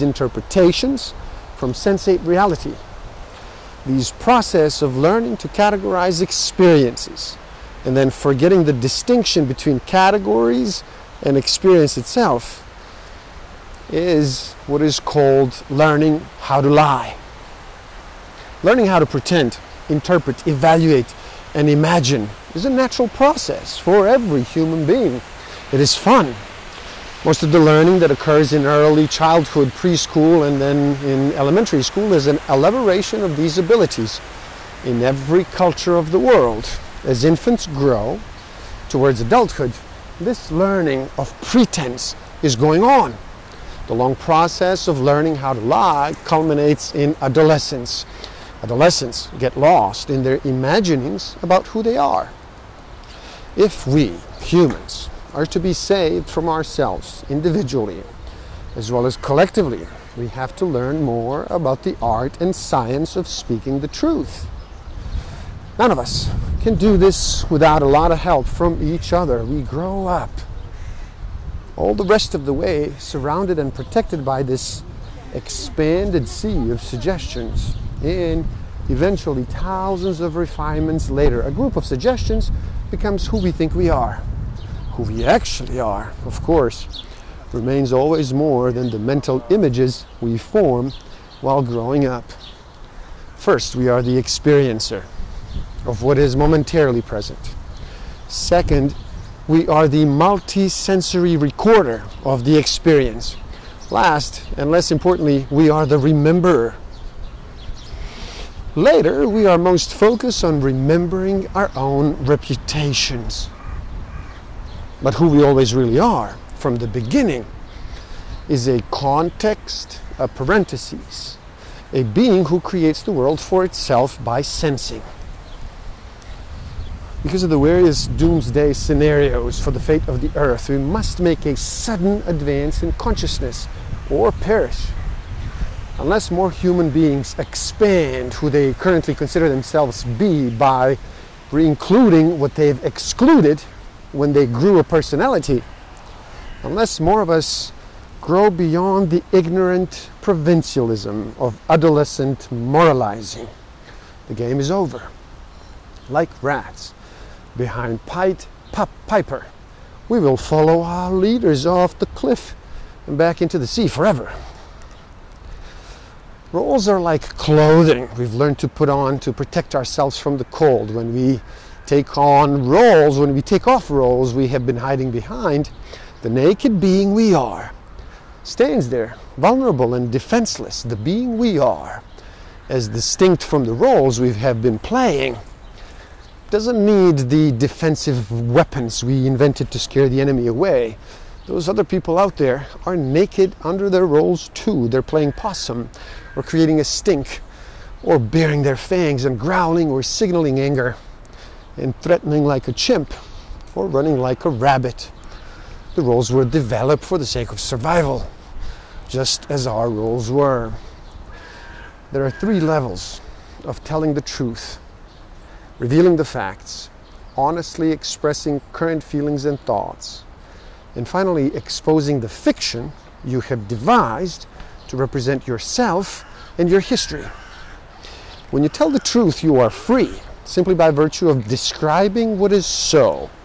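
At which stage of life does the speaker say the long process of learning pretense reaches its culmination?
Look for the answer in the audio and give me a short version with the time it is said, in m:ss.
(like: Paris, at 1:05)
Adolescence, at 0:47.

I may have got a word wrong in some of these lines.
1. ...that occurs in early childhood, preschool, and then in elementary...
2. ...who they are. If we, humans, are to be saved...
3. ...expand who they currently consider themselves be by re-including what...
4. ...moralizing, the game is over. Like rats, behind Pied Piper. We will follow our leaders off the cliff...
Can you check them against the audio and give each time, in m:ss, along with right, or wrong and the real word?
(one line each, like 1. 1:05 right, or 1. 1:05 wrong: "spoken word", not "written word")
1. 0:27 right
2. 0:51 right
3. 2:17 right
4. 2:32 right.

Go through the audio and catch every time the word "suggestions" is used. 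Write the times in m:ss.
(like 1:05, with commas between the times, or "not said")
1:16, 1:21.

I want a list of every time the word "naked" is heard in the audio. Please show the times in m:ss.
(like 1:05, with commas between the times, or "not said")
2:56, 3:12.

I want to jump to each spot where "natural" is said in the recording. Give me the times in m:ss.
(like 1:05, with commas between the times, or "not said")
0:22.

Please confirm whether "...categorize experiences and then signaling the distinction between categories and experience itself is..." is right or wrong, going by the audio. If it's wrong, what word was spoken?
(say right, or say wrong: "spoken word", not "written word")
wrong: "forgetting", not "signaling".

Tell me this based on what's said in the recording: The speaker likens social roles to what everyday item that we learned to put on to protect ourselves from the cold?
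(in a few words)
Clothing.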